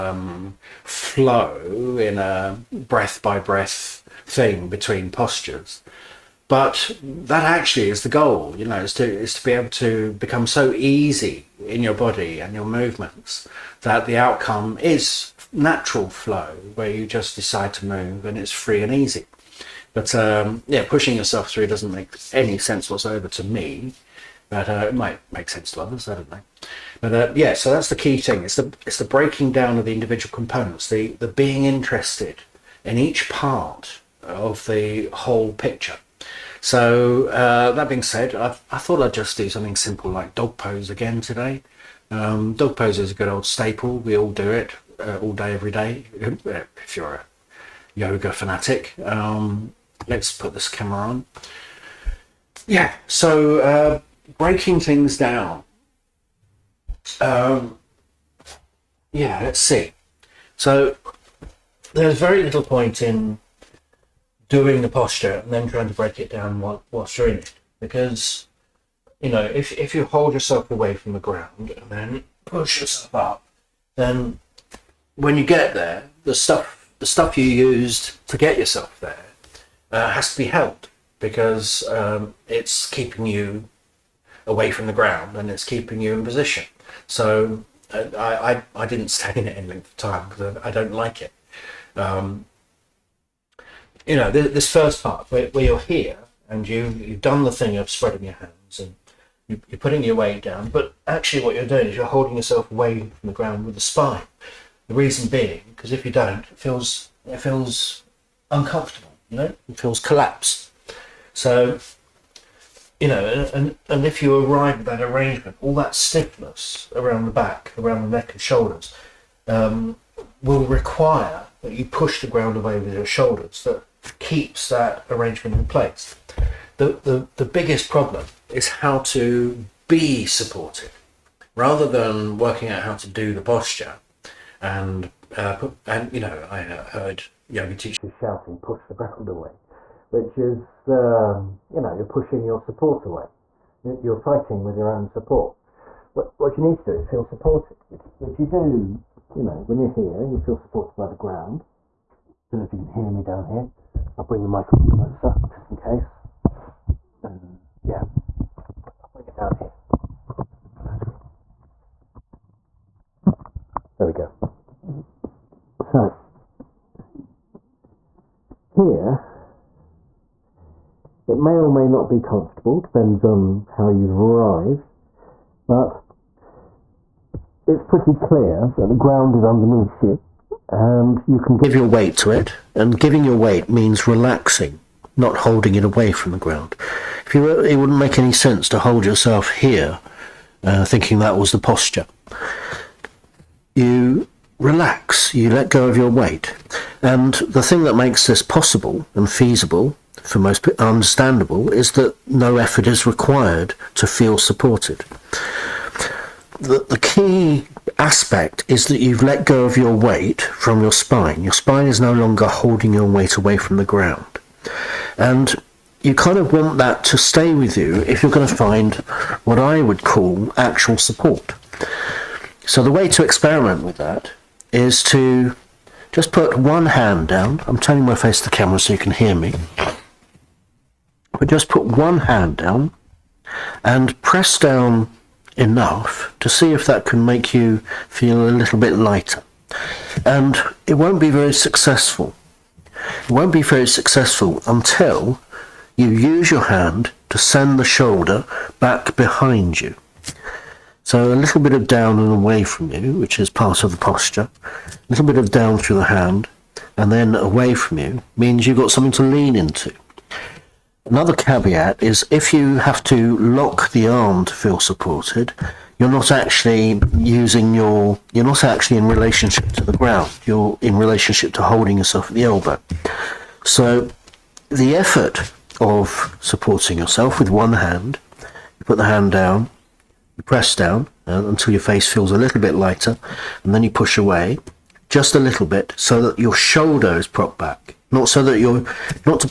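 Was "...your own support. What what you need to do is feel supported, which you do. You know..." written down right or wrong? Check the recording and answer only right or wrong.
right.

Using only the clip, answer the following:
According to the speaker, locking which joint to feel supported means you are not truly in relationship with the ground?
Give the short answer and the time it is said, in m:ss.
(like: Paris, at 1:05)
The elbow, at 4:32.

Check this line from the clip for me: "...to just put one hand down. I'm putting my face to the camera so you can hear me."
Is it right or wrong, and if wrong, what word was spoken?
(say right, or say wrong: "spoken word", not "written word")
wrong: "turning", not "putting".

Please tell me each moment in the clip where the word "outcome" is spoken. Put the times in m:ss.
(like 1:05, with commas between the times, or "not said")
0:14.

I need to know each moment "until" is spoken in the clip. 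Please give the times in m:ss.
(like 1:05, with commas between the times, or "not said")
4:04, 4:41.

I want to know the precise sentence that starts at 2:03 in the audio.
That keeps that arrangement in place.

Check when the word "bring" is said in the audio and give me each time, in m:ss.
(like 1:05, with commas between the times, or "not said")
2:34, 2:39.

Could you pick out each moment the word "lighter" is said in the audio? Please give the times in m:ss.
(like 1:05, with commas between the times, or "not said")
3:58, 4:42.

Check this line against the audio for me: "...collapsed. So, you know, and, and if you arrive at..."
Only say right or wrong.
right.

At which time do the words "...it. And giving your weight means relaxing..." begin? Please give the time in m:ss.
3:02.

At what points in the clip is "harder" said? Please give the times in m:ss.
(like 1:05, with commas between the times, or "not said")
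not said.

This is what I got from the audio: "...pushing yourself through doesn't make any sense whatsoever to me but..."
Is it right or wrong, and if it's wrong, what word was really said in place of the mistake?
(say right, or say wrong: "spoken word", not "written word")
right.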